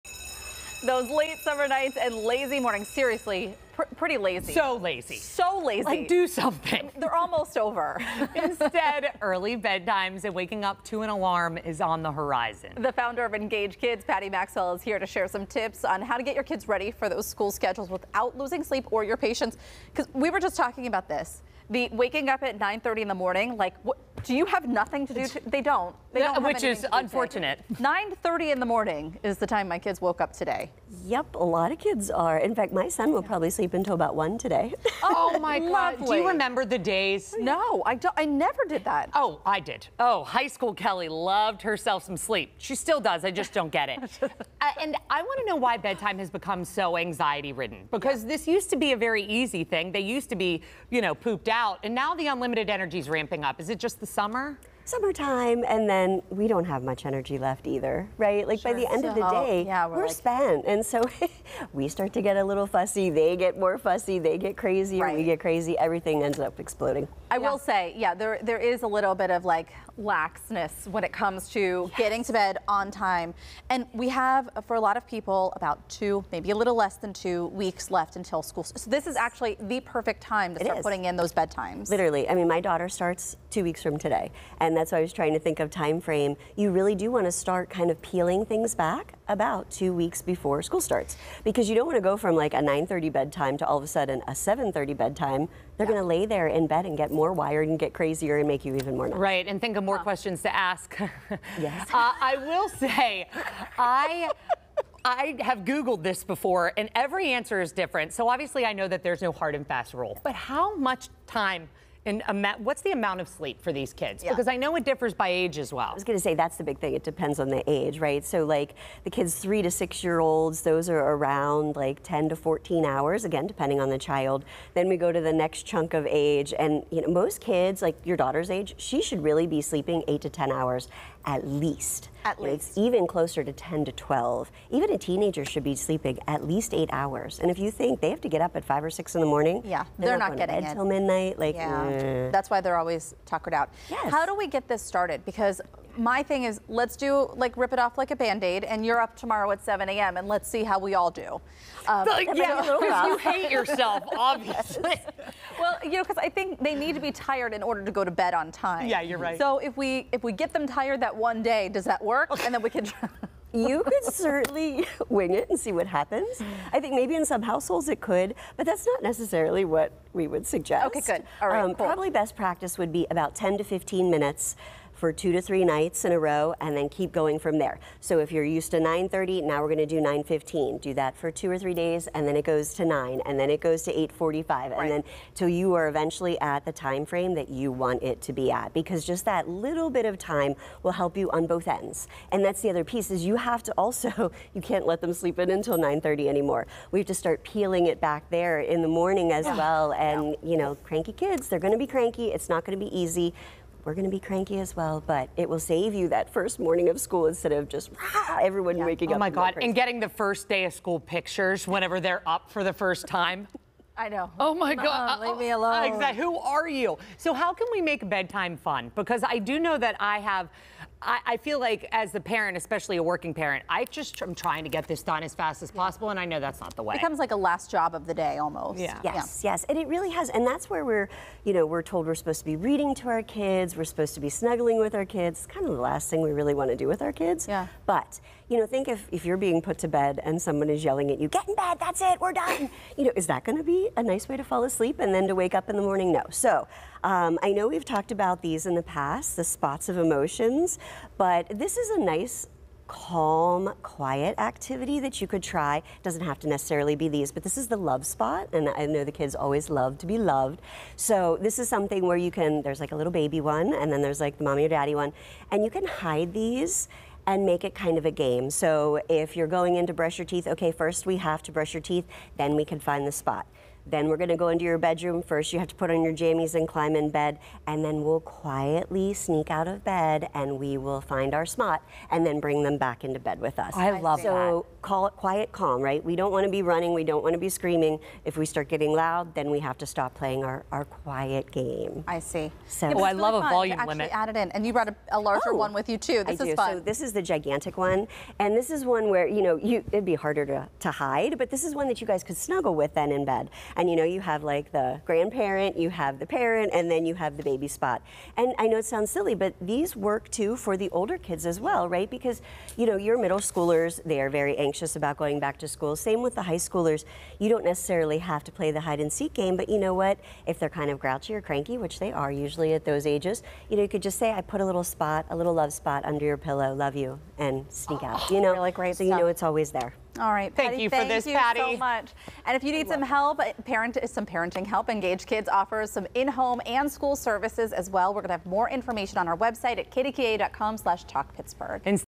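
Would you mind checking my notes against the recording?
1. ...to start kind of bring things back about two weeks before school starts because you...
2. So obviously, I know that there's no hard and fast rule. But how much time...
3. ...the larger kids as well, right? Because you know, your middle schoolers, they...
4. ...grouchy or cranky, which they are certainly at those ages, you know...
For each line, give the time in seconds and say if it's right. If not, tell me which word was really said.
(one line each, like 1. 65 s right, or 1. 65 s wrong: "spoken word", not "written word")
1. 87 s wrong: "peeling", not "bring"
2. 108 s right
3. 310 s wrong: "older", not "larger"
4. 320 s wrong: "usually", not "certainly".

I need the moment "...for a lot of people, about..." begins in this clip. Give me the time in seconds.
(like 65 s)
74 s.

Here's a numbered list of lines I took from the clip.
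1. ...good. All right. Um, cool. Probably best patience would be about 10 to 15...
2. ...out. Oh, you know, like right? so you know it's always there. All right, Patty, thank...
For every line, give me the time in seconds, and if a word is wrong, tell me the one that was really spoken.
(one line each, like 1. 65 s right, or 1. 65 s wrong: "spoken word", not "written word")
1. 171 s wrong: "practice", not "patience"
2. 328 s right.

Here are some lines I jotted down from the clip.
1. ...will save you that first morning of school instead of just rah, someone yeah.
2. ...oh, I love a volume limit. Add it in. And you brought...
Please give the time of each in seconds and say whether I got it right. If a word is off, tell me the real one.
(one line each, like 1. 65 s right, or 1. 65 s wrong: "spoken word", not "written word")
1. 205 s wrong: "everyone", not "someone"
2. 292 s right.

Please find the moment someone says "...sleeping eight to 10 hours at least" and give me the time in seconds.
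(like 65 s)
129 s.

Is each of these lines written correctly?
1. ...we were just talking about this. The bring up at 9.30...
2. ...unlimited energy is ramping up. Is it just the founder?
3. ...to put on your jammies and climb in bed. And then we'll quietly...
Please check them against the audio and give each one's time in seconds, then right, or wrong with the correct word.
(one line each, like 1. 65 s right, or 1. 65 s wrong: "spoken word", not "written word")
1. 20 s wrong: "waking", not "bring"
2. 52 s wrong: "summer", not "founder"
3. 275 s right.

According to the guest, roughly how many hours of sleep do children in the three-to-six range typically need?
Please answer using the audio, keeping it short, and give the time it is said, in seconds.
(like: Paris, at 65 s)
10 to 14 hours, at 122 s.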